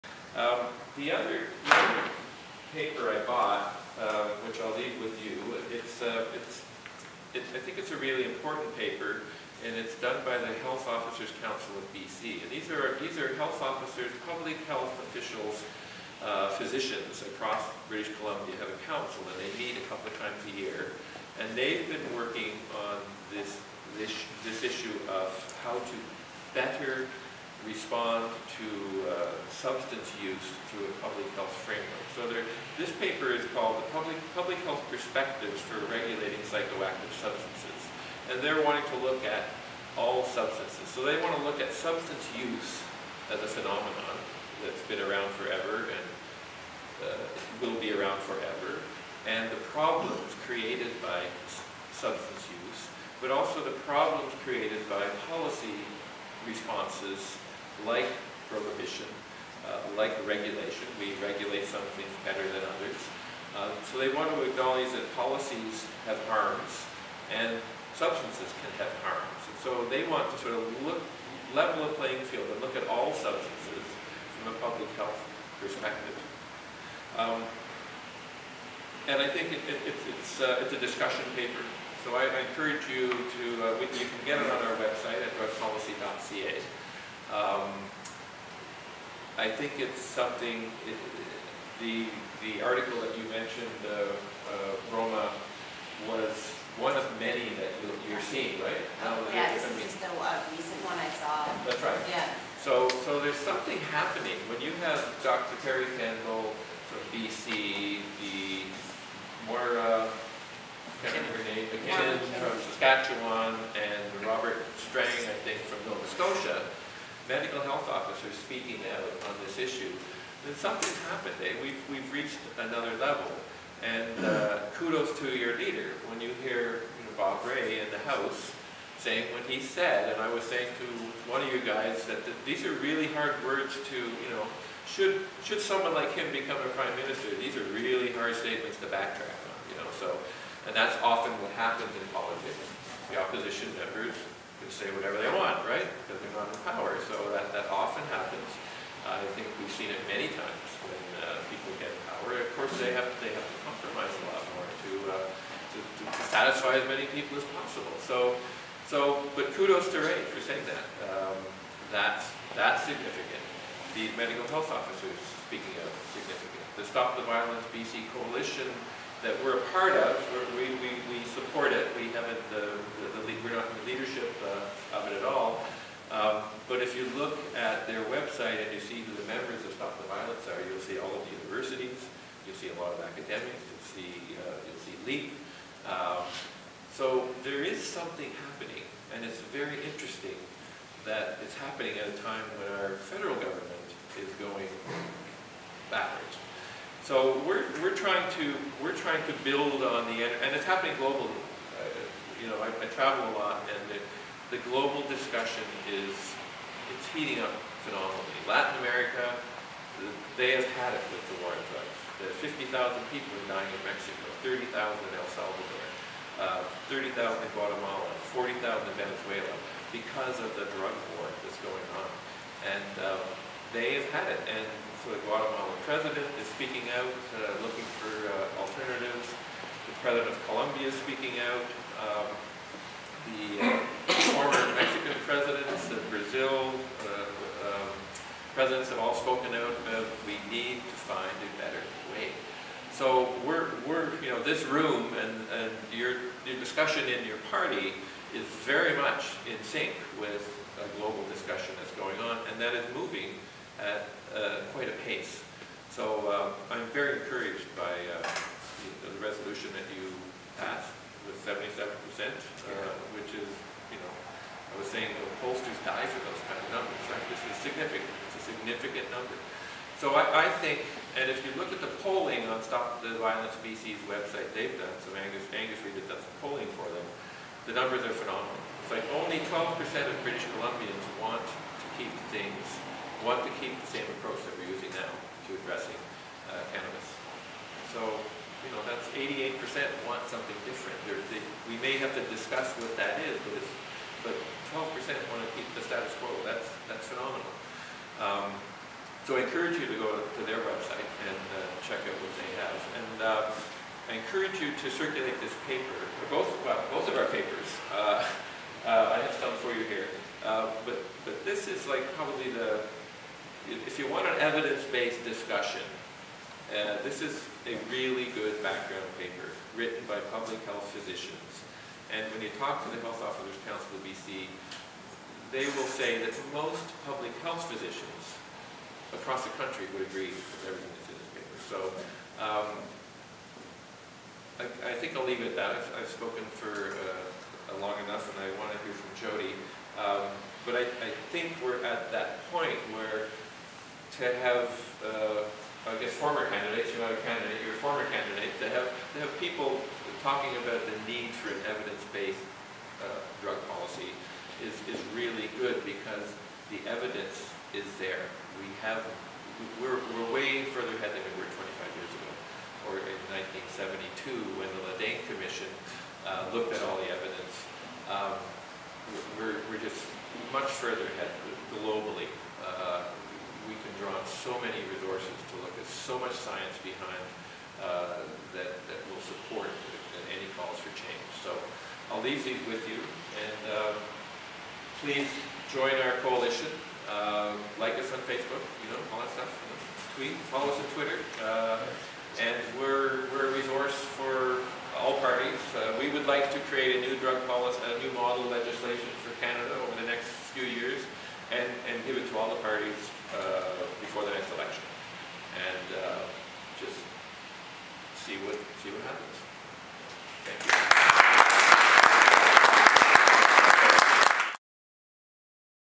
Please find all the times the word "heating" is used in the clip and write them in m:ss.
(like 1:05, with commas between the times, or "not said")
3:27.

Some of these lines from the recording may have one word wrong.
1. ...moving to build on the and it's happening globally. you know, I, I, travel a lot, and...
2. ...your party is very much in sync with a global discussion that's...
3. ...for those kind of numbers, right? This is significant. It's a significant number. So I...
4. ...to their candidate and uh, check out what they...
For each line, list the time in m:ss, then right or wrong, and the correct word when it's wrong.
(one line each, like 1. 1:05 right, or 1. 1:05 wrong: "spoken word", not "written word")
1. 3:18 wrong: "trying", not "moving"
2. 4:07 right
3. 4:26 right
4. 5:00 wrong: "website", not "candidate".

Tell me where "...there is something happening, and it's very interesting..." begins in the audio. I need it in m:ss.
3:07.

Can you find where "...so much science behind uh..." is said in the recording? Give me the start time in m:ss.
6:15.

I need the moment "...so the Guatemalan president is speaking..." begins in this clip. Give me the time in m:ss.
3:45.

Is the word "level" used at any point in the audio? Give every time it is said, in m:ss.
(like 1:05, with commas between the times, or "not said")
1:11, 2:02.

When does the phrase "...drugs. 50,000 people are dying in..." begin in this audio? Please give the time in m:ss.
3:31.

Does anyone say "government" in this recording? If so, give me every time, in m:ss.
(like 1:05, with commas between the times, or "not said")
3:13.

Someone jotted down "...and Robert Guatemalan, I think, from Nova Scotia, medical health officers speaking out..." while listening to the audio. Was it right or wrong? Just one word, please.
wrong.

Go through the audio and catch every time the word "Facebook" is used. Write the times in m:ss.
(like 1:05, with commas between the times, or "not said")
6:28.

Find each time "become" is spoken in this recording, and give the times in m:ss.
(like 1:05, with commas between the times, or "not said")
2:16.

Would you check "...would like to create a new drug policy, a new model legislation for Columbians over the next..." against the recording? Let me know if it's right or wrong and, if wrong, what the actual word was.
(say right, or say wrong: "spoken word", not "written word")
wrong: "Canada", not "Columbians".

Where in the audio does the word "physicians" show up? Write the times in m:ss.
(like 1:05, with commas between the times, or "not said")
0:16, 5:20, 5:27.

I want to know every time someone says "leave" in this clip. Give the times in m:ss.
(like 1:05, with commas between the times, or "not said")
0:04, 5:35, 6:22.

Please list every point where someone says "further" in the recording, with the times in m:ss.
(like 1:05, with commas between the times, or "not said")
6:00, 6:10.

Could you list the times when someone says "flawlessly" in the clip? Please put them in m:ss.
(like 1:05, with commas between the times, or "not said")
not said.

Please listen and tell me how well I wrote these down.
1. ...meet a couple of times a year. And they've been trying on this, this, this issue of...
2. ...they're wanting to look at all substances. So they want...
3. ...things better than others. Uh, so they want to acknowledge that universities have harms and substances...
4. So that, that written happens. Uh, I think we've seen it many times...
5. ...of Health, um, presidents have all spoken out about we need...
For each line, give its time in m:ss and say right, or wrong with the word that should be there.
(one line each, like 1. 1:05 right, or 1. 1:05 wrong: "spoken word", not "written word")
1. 0:19 wrong: "working", not "trying"
2. 0:38 right
3. 1:01 wrong: "policies", not "universities"
4. 2:27 wrong: "often", not "written"
5. 3:55 wrong: "Brazil", not "Health".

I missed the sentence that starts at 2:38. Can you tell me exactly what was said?
So so, but kudos to Rae for saying that.